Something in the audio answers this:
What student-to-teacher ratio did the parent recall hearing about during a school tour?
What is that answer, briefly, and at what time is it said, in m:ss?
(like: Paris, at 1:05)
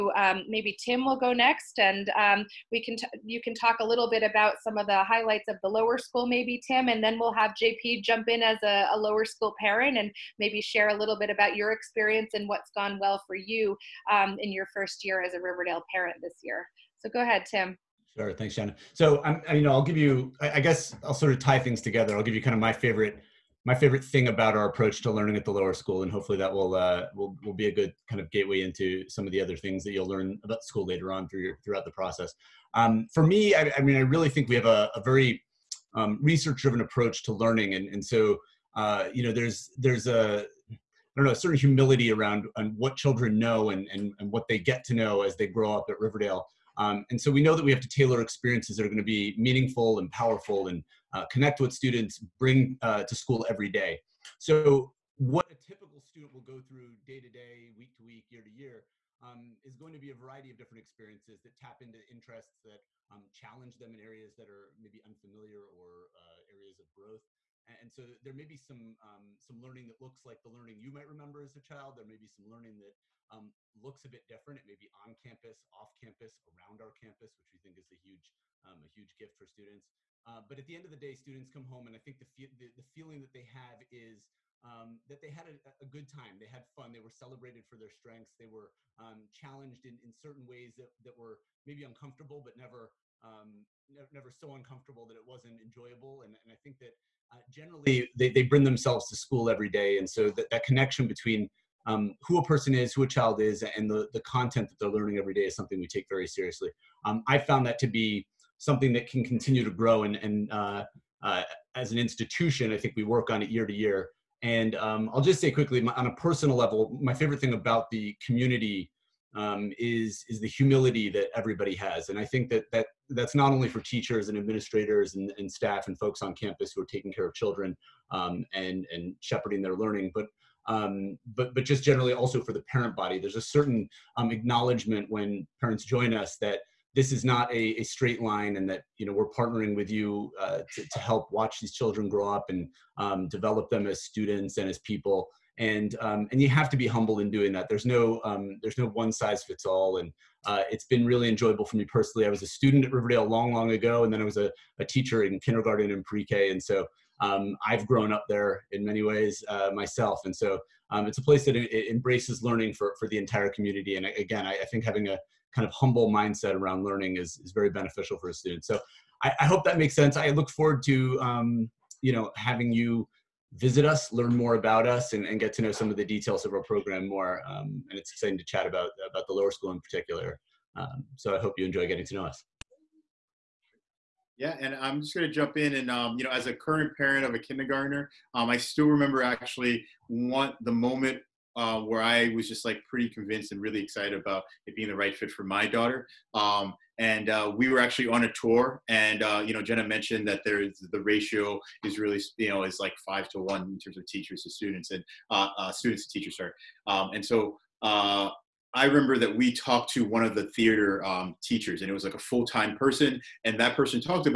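5 to 1, at 3:23.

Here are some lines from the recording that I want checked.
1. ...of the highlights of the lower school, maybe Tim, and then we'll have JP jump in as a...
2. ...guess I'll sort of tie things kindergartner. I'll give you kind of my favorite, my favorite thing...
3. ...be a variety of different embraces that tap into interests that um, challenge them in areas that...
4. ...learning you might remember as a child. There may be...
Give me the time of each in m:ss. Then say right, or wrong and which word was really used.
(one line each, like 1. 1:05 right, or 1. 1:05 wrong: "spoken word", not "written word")
1. 0:04 right
2. 0:20 wrong: "together", not "kindergartner"
3. 1:00 wrong: "experiences", not "embraces"
4. 1:10 right.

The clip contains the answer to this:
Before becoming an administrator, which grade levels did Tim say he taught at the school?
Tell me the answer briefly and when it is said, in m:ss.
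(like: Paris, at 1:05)
kindergarten and pre-K, at 2:35.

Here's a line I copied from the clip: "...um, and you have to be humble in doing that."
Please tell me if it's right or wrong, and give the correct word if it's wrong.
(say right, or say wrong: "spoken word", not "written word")
right.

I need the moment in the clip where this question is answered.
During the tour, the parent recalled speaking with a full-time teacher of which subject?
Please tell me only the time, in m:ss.
3:30.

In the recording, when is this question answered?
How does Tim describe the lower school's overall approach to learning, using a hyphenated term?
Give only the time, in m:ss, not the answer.
0:36.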